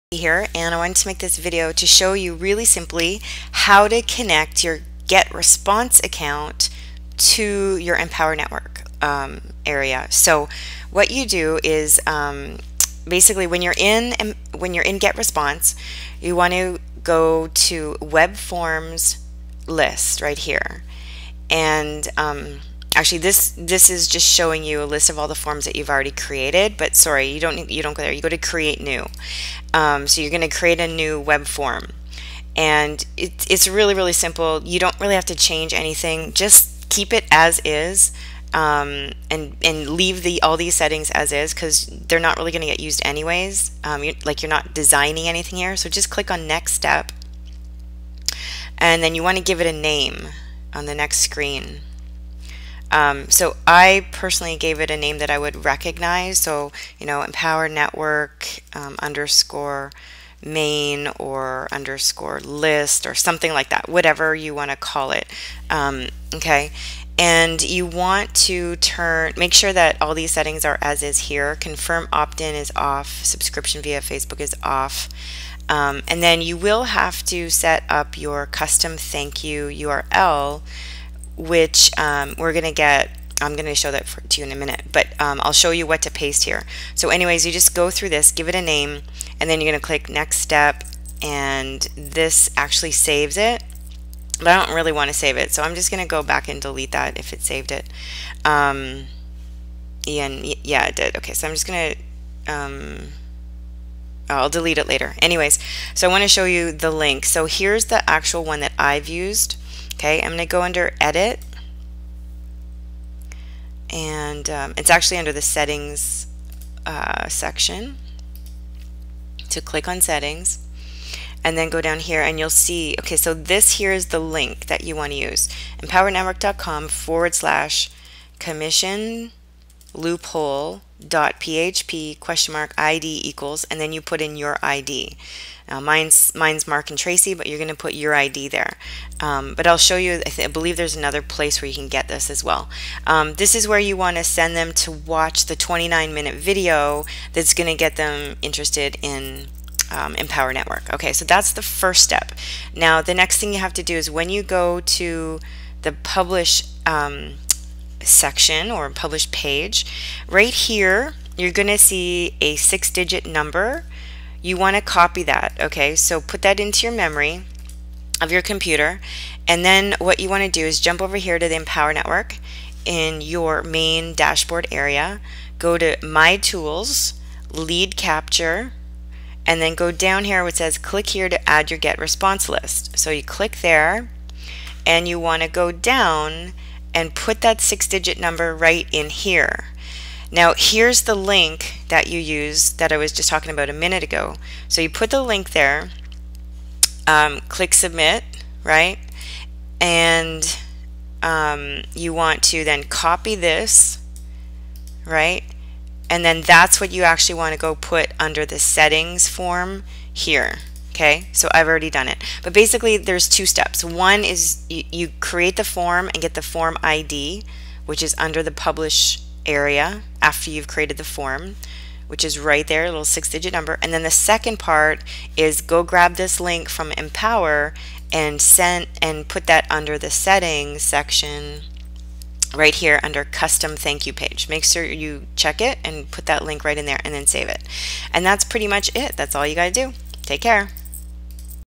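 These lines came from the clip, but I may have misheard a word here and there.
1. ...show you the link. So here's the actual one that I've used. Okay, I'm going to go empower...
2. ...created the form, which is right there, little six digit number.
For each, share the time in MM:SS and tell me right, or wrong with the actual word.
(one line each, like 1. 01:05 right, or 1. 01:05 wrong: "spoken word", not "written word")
1. 01:46 wrong: "under", not "empower"
2. 03:40 right.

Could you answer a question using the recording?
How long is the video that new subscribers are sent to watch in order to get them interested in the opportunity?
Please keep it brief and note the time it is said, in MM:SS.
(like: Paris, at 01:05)
29 minutes, at 02:25.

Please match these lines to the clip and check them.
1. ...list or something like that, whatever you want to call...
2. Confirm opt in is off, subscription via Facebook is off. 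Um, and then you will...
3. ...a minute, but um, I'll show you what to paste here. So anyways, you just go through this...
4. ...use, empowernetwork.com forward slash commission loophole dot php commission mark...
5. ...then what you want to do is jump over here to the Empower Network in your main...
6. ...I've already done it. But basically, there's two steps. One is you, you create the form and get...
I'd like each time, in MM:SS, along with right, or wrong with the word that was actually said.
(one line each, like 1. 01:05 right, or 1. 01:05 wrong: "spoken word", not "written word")
1. 01:02 right
2. 01:11 right
3. 01:24 right
4. 02:05 wrong: "question", not "commission"
5. 02:49 right
6. 03:31 right.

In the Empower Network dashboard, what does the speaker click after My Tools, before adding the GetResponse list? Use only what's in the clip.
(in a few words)
Lead Capture.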